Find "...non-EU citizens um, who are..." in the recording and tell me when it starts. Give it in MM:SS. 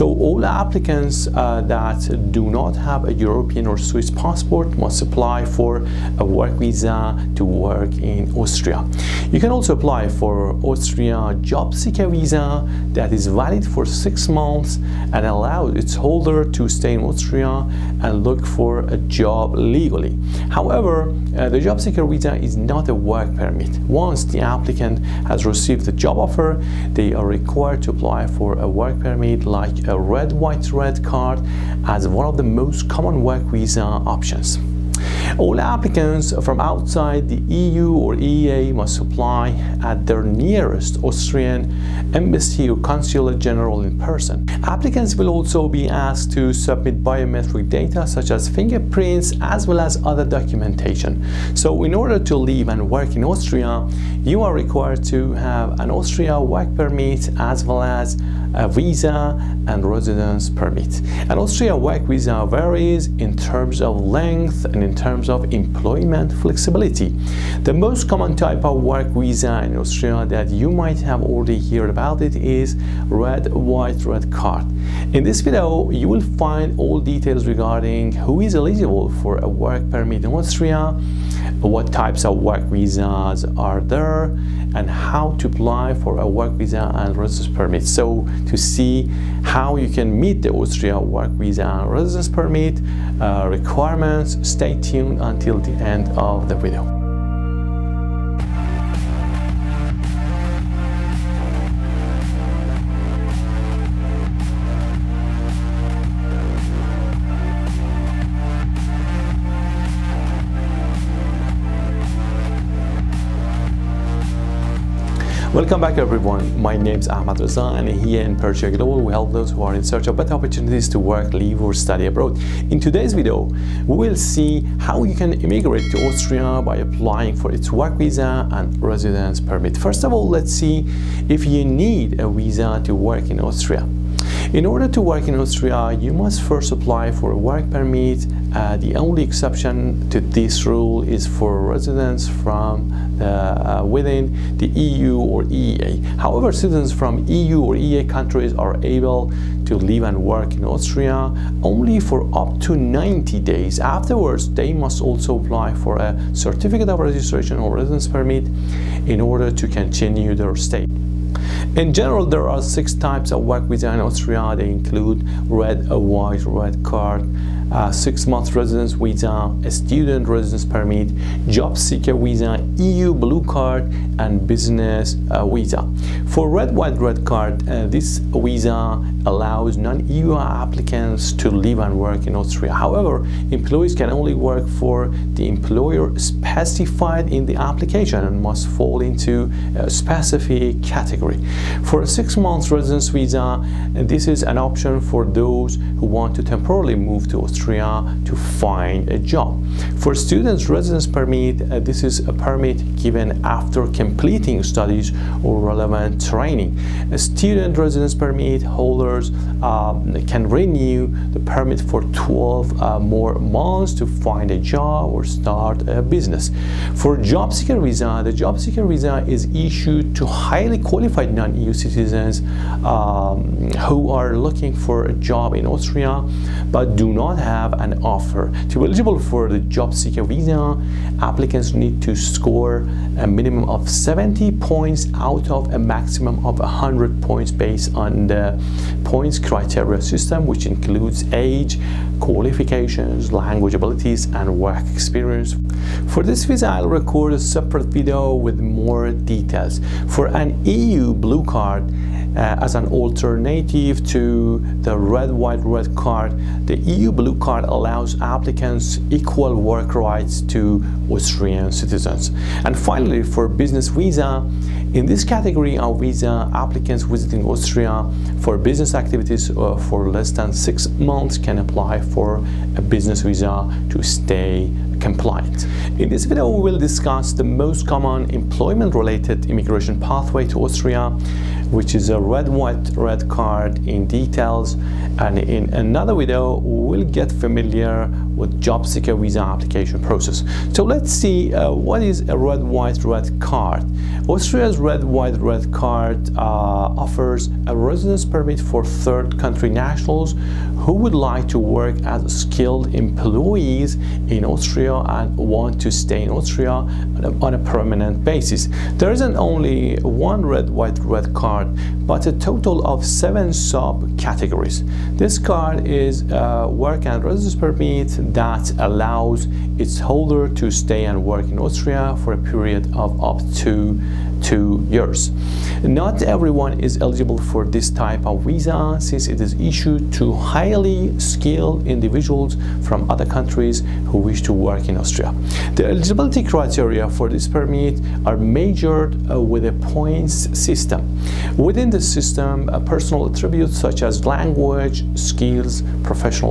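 03:41.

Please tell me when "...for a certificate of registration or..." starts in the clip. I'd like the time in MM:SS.
02:35.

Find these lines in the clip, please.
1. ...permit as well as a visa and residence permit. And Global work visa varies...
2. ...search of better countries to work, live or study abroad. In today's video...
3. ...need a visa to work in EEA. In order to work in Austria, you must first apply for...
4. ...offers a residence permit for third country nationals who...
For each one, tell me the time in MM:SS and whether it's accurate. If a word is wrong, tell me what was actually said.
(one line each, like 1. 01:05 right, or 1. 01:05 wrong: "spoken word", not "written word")
1. 00:56 wrong: "Austria", not "Global"
2. 01:59 wrong: "opportunities", not "countries"
3. 02:11 wrong: "Austria", not "EEA"
4. 04:57 right.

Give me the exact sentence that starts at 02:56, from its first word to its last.
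For red, white, red card, uh, this visa allows non-EU applicants to live and work in Austria.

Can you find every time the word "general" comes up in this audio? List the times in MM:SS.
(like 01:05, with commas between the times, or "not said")
00:43, 02:41.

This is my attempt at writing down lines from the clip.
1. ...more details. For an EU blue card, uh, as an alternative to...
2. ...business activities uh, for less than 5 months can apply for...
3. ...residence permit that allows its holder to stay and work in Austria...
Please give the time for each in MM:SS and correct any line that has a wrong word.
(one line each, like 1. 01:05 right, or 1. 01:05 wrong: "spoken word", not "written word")
1. 04:08 right
2. 04:28 wrong: "6", not "5"
3. 05:17 right.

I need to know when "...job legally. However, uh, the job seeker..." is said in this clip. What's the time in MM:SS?
00:18.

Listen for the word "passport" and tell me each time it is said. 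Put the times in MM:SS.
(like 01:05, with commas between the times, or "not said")
00:04.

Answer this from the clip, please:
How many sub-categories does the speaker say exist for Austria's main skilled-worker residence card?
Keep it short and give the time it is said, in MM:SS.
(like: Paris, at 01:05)
7, at 05:13.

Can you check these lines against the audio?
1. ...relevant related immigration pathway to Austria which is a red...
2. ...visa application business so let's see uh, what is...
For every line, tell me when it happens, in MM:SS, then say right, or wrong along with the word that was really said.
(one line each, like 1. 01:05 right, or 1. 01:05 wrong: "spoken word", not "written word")
1. 04:38 wrong: "employment", not "relevant"
2. 04:49 wrong: "process", not "business".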